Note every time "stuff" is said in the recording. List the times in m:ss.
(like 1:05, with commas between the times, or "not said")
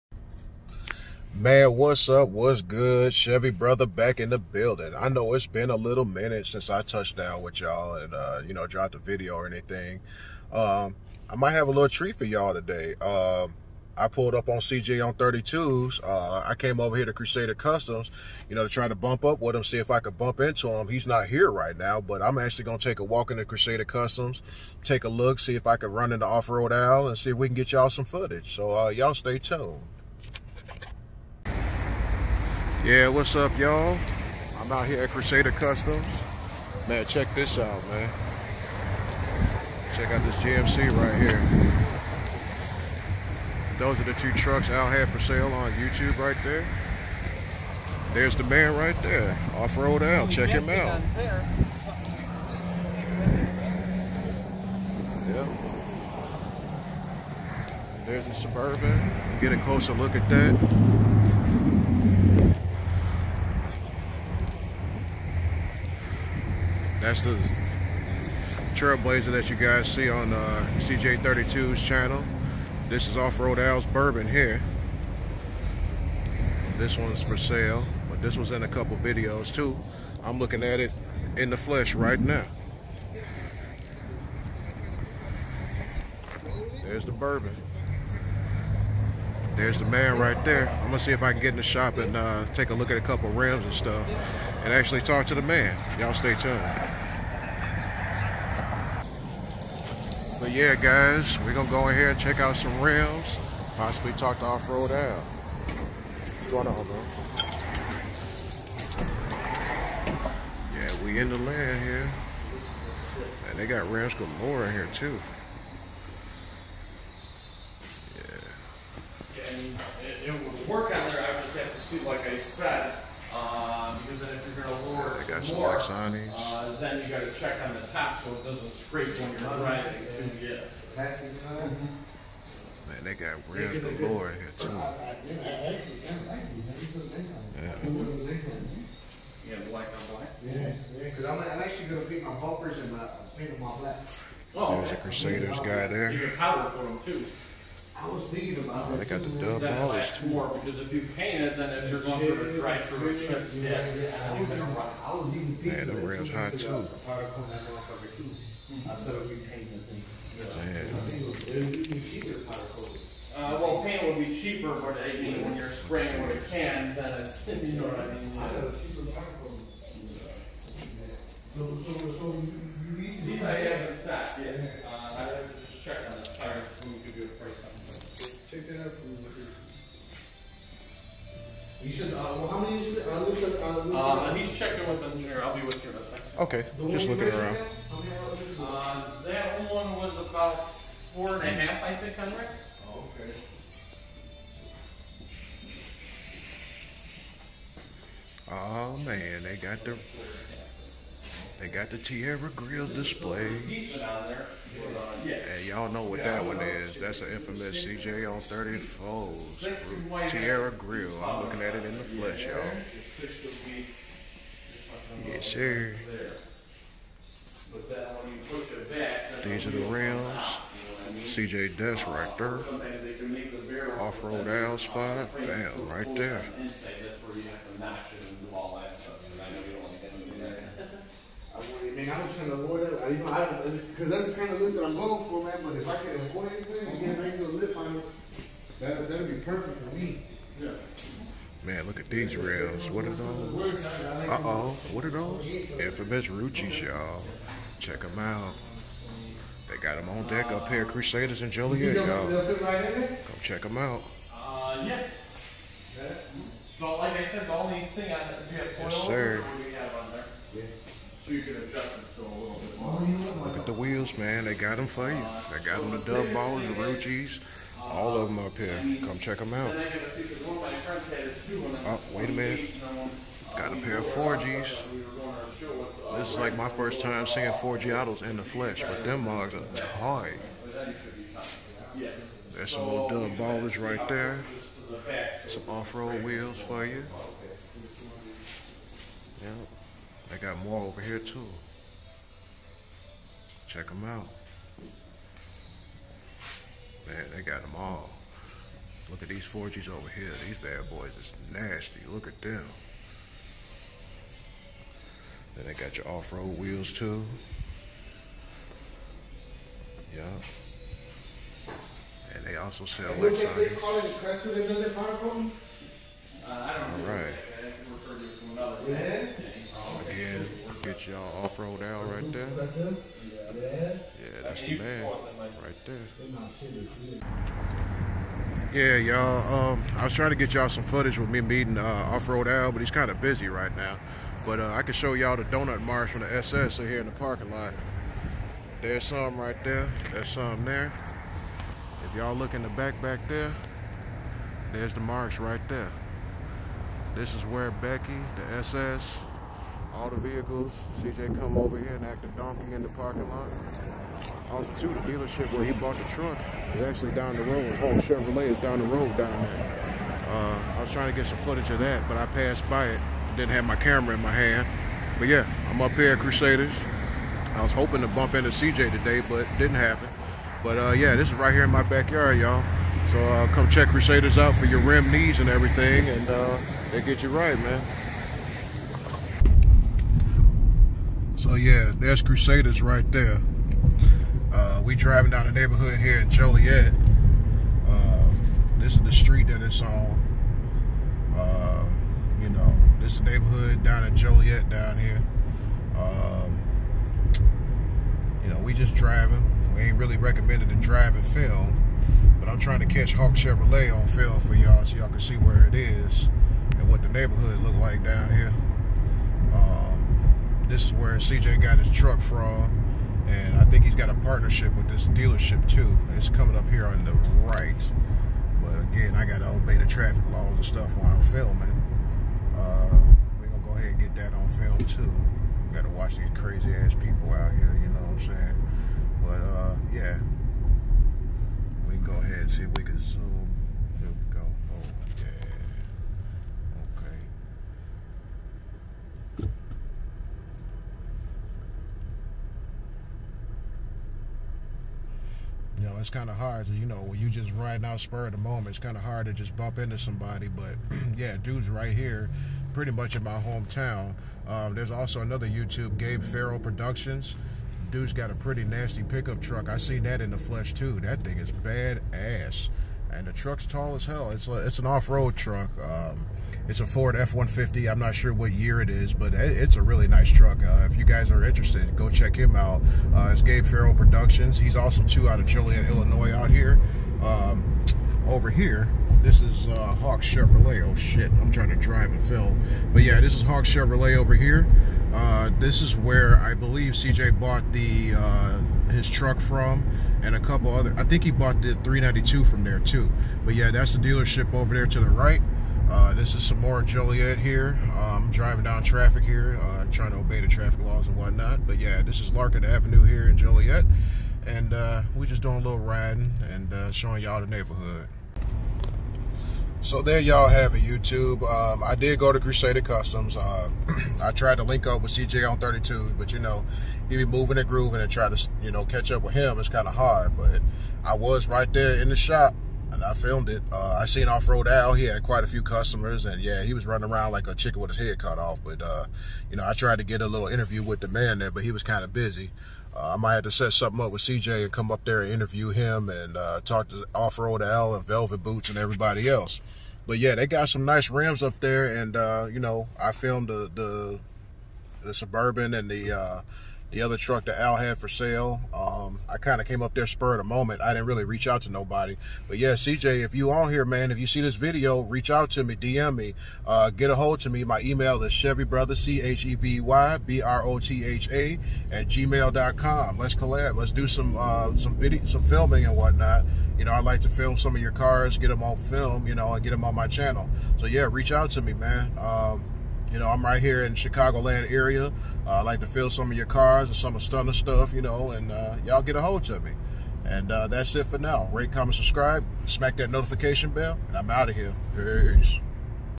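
1:33, 7:00, 9:37.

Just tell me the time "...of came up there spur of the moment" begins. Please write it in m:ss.
9:09.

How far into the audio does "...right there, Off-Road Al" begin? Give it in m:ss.
0:48.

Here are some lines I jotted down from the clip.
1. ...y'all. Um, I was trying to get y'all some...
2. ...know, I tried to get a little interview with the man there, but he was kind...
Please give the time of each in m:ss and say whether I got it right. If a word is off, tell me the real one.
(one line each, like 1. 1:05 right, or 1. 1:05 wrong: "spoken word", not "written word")
1. 5:28 right
2. 8:49 right.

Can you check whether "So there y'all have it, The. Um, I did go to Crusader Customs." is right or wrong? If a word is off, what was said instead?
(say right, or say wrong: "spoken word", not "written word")
wrong: "YouTube", not "The".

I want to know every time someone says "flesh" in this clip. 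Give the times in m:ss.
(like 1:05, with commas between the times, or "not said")
1:21, 3:32, 4:38, 7:40.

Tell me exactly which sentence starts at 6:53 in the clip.
And I think he's got a partnership with this dealership too.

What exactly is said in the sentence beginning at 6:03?
Didn't have my camera in my hand.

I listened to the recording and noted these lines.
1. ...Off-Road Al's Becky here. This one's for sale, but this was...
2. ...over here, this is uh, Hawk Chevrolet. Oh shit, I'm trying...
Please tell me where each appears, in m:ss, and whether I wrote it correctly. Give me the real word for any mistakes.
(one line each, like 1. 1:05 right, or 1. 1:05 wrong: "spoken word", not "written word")
1. 1:13 wrong: "Bourbon", not "Becky"
2. 7:58 right.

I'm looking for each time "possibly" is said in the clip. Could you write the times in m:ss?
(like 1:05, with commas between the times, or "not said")
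1:43.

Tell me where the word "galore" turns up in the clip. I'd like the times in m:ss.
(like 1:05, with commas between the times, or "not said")
1:54, 2:13.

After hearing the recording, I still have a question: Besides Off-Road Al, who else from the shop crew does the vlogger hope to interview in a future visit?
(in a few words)
Velvet Boots.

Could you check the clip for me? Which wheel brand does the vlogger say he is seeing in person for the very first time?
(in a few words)
Forgiatos.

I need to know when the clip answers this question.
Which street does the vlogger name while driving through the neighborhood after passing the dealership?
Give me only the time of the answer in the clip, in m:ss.
8:22.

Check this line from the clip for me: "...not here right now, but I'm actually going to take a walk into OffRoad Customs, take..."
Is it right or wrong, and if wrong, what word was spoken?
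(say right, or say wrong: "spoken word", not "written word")
wrong: "Crusader", not "OffRoad".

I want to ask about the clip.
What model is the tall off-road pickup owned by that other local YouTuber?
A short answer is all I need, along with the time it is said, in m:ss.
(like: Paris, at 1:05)
Ford F-150, at 7:46.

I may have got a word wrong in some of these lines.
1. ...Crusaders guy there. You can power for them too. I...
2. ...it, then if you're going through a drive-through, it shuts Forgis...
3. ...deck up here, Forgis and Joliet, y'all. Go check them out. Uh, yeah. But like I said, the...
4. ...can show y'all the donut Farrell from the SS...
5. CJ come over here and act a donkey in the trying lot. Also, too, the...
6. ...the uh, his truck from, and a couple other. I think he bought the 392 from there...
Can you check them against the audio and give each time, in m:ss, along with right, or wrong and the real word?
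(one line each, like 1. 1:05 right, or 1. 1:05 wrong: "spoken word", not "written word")
1. 2:24 right
2. 2:31 wrong: "Yeah", not "Forgis"
3. 4:10 wrong: "Crusaders", not "Forgis"
4. 5:34 wrong: "Marsh", not "Farrell"
5. 5:50 wrong: "parking", not "trying"
6. 8:07 right.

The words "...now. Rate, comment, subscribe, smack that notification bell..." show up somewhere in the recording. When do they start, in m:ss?
9:41.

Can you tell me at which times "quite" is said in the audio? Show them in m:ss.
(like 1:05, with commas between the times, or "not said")
8:45.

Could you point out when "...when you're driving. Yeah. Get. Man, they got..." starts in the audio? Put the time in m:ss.
2:09.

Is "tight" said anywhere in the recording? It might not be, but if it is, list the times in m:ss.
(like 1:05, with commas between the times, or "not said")
4:39.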